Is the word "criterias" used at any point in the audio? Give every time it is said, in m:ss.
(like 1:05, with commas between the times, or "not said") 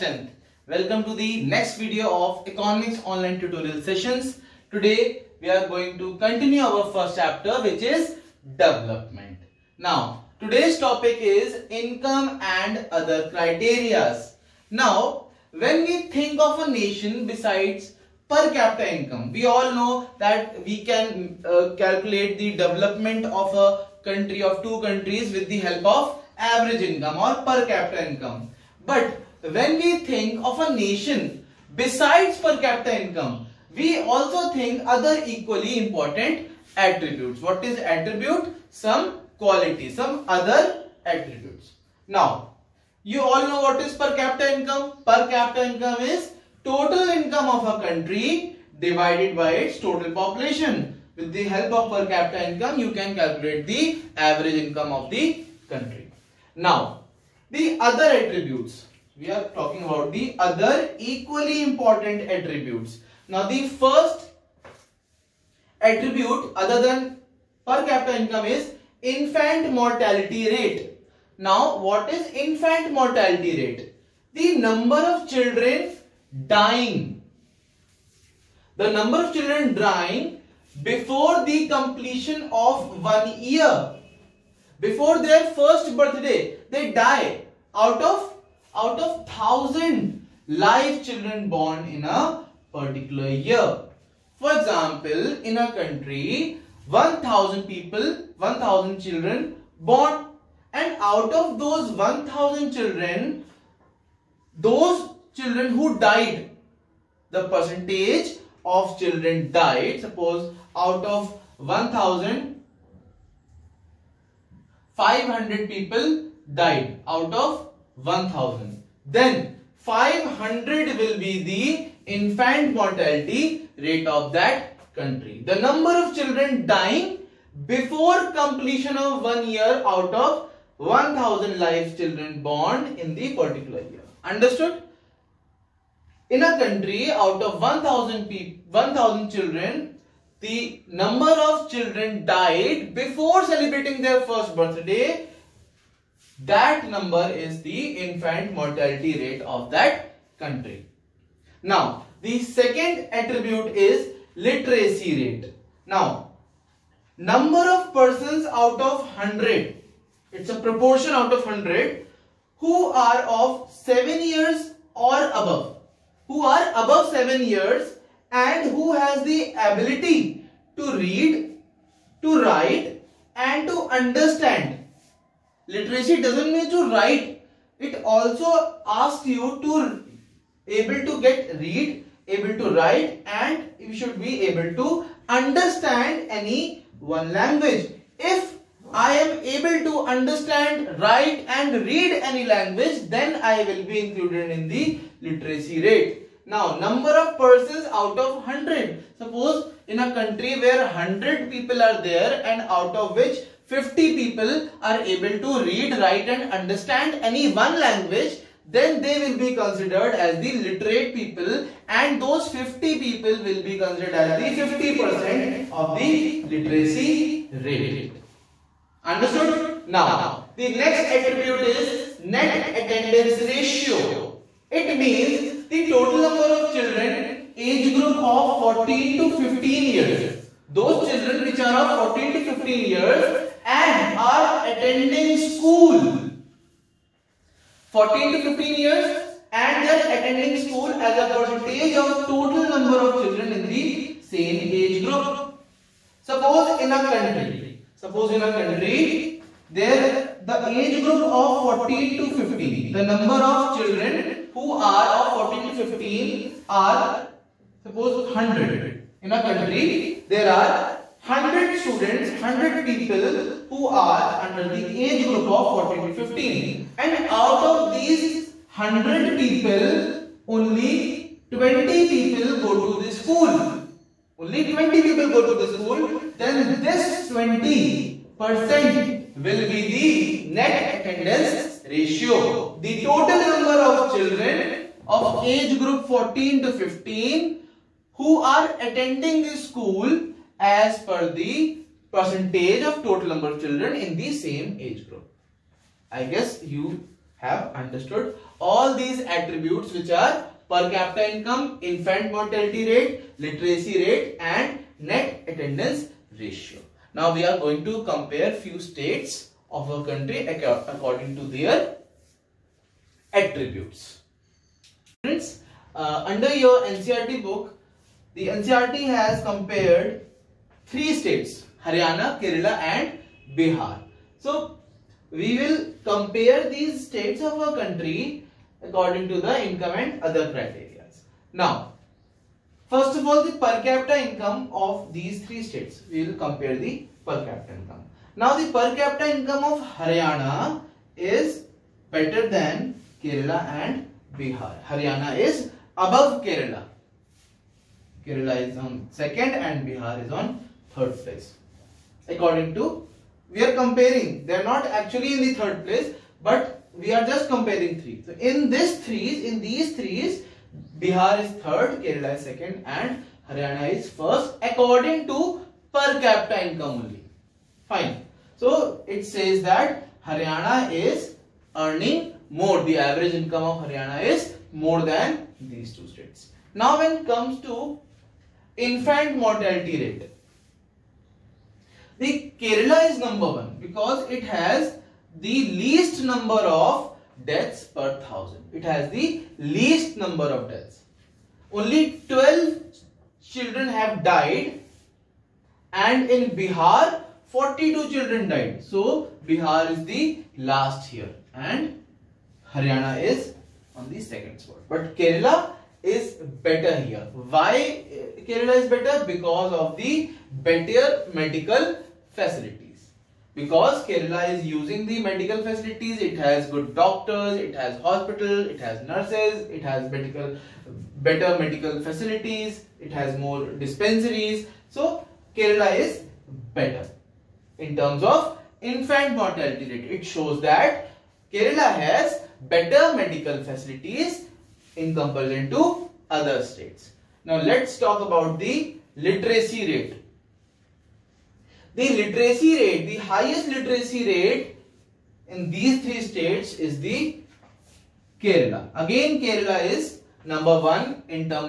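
0:13, 5:30.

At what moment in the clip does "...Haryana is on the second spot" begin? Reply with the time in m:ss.
6:42.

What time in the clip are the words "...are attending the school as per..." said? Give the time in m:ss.
4:48.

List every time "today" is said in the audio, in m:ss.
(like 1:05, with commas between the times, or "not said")
0:04, 0:10.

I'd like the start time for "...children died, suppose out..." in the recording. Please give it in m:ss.
1:48.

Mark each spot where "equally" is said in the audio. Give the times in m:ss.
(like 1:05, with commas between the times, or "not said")
0:35, 1:00.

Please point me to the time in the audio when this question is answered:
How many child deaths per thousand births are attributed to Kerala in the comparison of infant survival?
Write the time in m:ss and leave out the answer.
6:31.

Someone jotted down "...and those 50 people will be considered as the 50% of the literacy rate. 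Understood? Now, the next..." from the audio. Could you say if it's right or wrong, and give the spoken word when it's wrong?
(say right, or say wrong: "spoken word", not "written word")
right.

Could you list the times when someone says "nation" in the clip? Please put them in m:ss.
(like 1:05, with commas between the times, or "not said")
0:16, 0:30.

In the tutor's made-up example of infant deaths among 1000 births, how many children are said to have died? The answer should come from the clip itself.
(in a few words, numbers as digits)
500.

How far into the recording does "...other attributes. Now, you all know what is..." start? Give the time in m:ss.
0:40.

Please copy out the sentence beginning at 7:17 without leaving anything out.
Now let's talk about the literacy rate the literacy rate, the highest literacy rate in these three states is the Kerala.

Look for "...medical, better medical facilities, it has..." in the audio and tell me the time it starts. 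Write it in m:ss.
7:00.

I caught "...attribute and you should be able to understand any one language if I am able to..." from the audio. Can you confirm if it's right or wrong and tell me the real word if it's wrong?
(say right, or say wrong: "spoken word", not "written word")
wrong: "write", not "attribute".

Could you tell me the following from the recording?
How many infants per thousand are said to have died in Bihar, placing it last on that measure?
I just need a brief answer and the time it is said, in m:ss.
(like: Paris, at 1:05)
42, at 6:37.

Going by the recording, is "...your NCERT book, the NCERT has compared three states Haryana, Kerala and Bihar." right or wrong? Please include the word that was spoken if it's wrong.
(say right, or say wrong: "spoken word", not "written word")
right.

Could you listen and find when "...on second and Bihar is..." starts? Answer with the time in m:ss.
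5:48.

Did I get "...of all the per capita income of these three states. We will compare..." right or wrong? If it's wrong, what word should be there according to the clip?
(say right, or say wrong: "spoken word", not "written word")
right.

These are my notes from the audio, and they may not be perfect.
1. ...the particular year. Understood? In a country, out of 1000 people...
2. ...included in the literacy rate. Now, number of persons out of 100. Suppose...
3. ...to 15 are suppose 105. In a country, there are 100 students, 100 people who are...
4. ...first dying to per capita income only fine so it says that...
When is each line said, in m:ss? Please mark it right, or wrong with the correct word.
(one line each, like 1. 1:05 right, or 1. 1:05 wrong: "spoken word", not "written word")
1. 2:13 right
2. 3:14 right
3. 4:15 wrong: "100", not "105"
4. 6:04 wrong: "according", not "dying".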